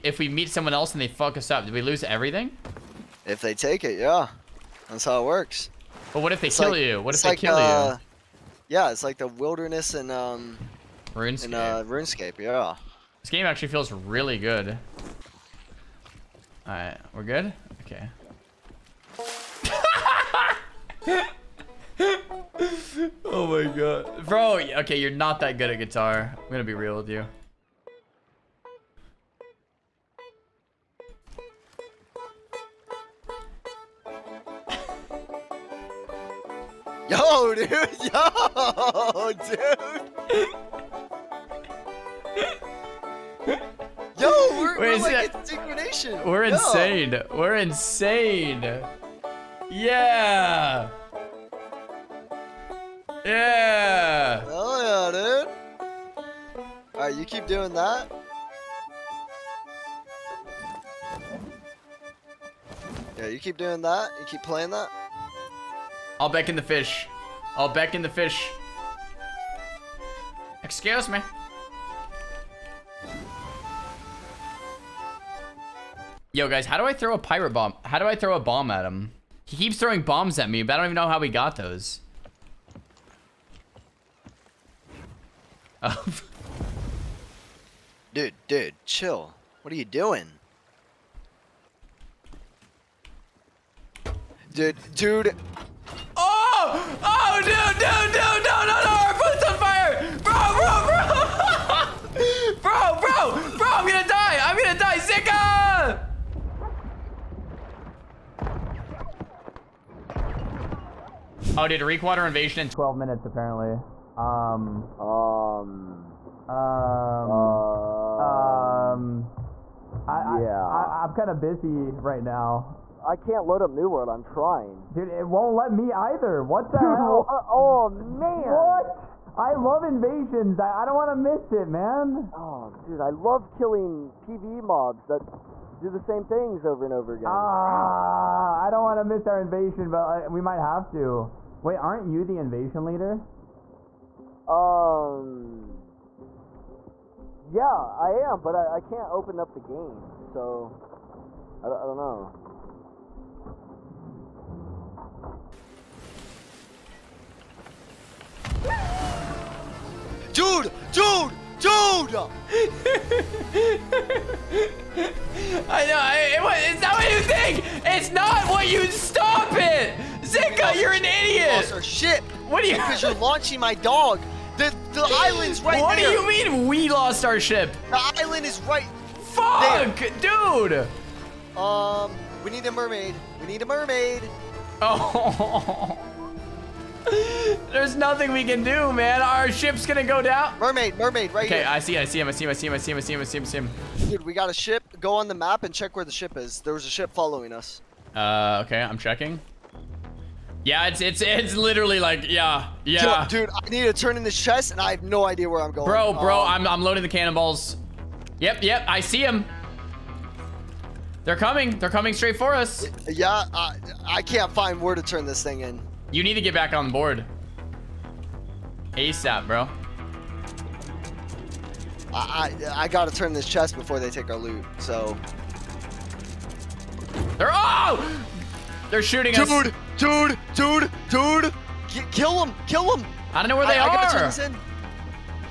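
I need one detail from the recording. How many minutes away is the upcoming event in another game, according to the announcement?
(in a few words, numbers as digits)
12.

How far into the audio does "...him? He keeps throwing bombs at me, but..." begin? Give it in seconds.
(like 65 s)
78 s.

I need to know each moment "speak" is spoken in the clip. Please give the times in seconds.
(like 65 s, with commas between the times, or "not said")
not said.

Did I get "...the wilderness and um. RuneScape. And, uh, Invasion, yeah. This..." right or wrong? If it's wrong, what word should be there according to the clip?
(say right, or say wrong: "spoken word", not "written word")
wrong: "RuneScape", not "Invasion".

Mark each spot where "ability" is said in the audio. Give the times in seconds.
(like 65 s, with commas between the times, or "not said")
not said.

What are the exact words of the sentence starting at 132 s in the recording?
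Oh, dude, I love killing PvE mobs that do the same things over and over again.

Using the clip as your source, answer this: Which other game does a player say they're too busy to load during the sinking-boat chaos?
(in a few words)
New World.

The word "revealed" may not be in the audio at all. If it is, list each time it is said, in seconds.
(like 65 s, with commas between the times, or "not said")
not said.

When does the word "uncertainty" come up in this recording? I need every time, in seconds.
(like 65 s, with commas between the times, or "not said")
not said.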